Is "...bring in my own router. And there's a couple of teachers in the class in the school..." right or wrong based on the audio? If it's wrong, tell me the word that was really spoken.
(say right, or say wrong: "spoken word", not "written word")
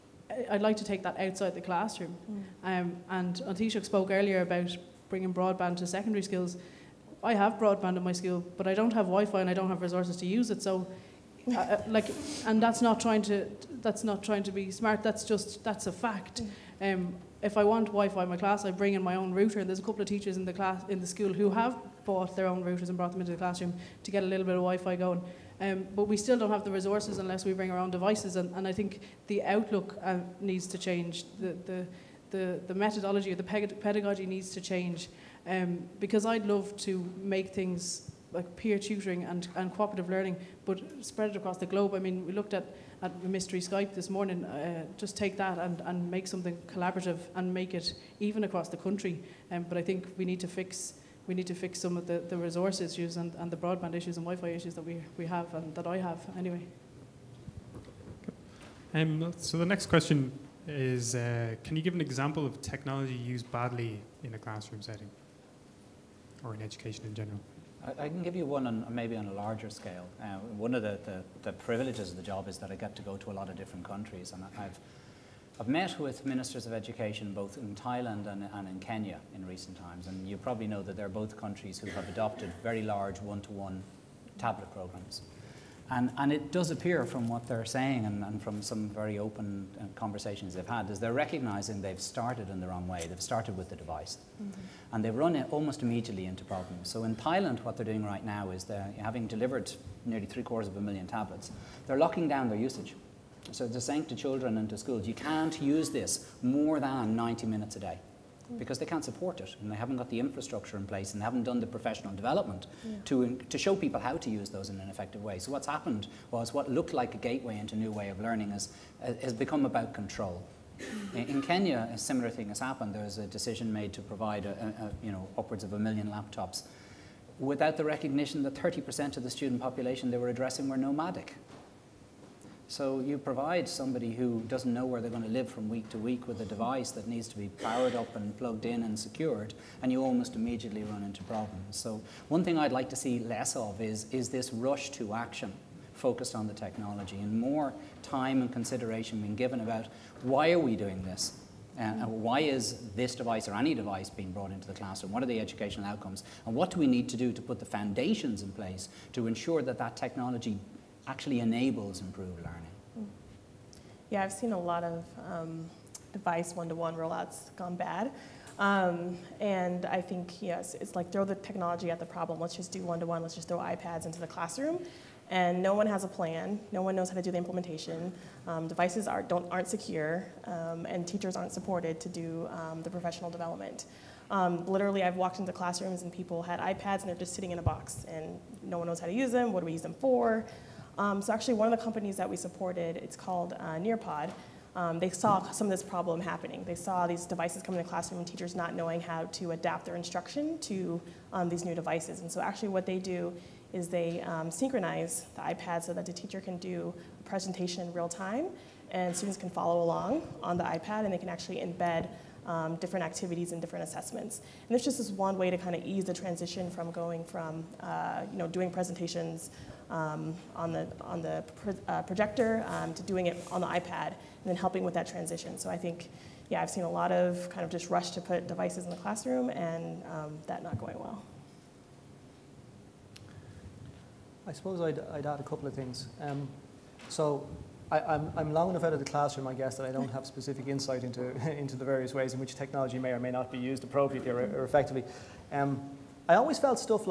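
right.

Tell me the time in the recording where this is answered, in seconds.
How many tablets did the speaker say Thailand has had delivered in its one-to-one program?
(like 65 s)
100 s.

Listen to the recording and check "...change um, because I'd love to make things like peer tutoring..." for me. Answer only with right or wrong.
right.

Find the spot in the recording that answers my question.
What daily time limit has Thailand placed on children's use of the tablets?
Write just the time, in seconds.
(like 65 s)
107 s.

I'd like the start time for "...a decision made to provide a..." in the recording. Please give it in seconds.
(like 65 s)
123 s.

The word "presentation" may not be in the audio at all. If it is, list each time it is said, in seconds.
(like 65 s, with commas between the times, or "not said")
207 s, 218 s.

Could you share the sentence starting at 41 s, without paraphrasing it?
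I mean, we looked at, at Mystery Skype this morning.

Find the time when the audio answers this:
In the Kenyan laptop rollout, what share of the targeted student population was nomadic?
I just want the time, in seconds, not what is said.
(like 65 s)
128 s.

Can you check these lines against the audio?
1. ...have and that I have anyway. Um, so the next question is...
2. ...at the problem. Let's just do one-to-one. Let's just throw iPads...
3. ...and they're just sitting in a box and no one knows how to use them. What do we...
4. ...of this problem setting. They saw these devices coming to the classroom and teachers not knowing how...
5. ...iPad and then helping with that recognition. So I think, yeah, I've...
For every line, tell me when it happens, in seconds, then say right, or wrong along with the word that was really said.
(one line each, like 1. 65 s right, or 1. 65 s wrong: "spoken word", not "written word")
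1. 55 s right
2. 171 s right
3. 187 s right
4. 195 s wrong: "happening", not "setting"
5. 223 s wrong: "transition", not "recognition".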